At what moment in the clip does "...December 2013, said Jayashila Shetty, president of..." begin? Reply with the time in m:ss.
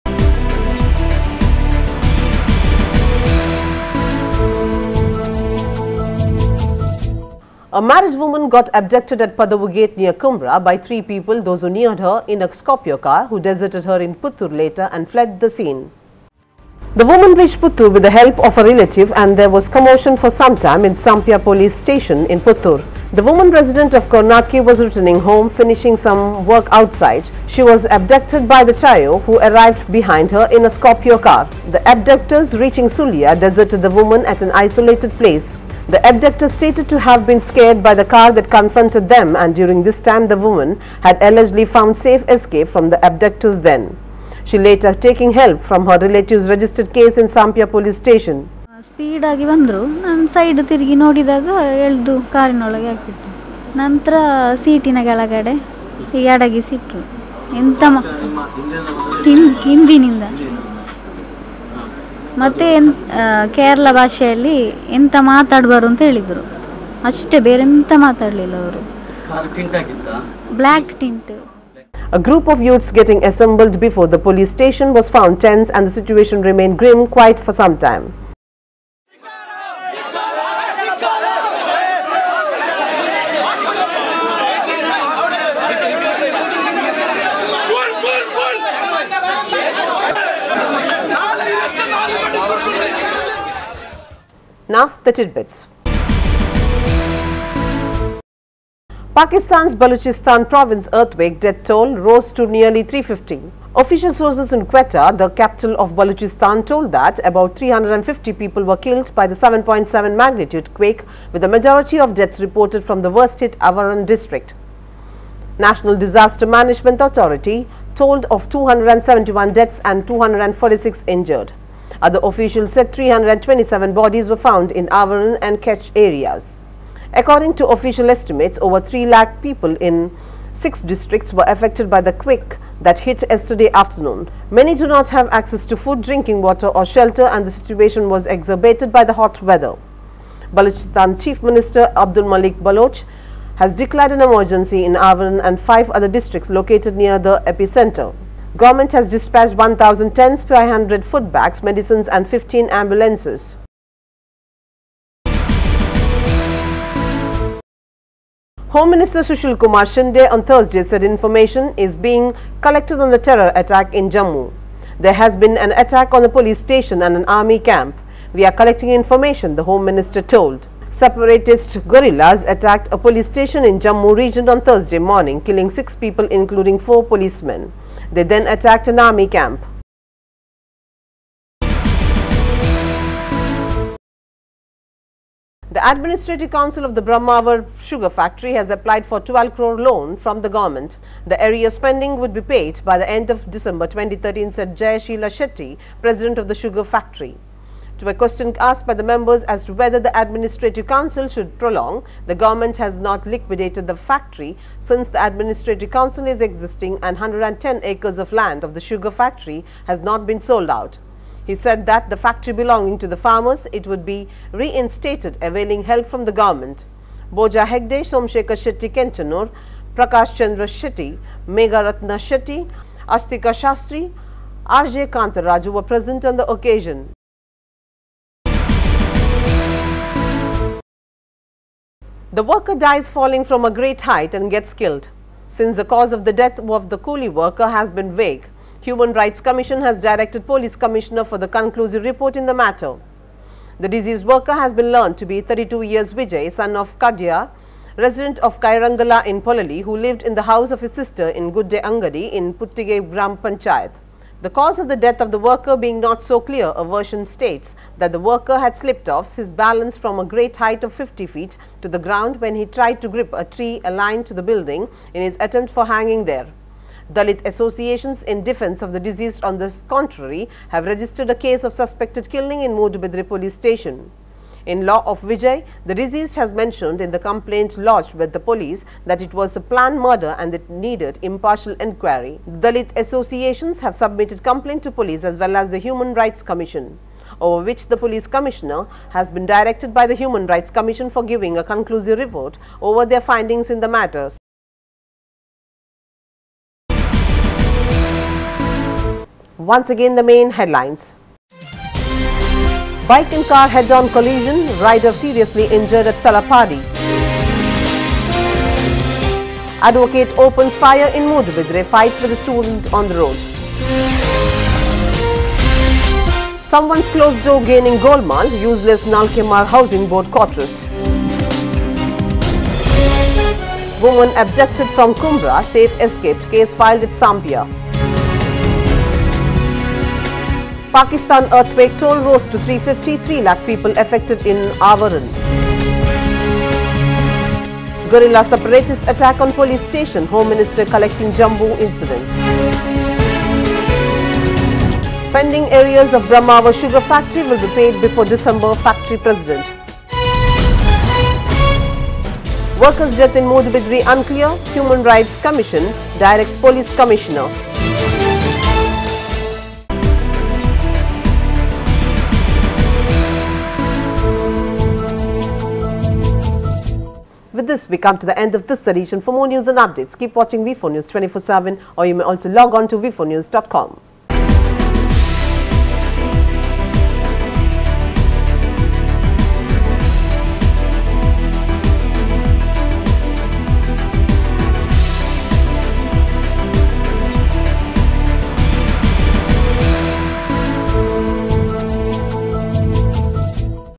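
3:13.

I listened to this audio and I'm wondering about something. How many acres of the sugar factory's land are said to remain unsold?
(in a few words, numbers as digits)
110.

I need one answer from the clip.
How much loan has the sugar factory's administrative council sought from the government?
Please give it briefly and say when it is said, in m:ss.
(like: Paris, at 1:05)
12 crore, at 3:09.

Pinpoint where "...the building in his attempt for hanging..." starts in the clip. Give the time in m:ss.
4:24.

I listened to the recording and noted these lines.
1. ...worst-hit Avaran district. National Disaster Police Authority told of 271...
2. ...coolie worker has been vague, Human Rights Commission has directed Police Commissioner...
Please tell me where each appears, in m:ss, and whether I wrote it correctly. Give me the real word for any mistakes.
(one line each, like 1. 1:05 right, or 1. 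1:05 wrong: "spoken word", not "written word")
1. 1:53 wrong: "Management", not "Police"
2. 3:56 right.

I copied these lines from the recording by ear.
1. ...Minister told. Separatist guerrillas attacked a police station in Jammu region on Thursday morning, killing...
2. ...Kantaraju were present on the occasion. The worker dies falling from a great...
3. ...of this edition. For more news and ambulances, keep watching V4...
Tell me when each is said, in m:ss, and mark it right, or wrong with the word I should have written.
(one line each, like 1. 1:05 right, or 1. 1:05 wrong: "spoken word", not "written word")
1. 2:49 right
2. 3:45 right
3. 6:08 wrong: "updates", not "ambulances".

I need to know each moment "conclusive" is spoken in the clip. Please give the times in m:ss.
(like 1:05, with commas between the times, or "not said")
4:01, 4:51.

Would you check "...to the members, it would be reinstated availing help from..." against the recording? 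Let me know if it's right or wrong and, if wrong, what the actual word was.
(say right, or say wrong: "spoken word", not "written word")
wrong: "farmers", not "members".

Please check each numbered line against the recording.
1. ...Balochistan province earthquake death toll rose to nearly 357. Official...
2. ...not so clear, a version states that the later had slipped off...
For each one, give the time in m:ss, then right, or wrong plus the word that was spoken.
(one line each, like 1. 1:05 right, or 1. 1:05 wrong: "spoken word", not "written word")
1. 1:39 wrong: "350", not "357"
2. 4:15 wrong: "worker", not "later".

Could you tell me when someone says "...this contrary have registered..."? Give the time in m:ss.
4:29.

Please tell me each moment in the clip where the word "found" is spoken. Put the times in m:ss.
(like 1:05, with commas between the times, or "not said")
0:41, 1:15, 2:04.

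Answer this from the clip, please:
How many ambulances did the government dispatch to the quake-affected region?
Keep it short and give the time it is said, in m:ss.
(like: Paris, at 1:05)
15, at 2:32.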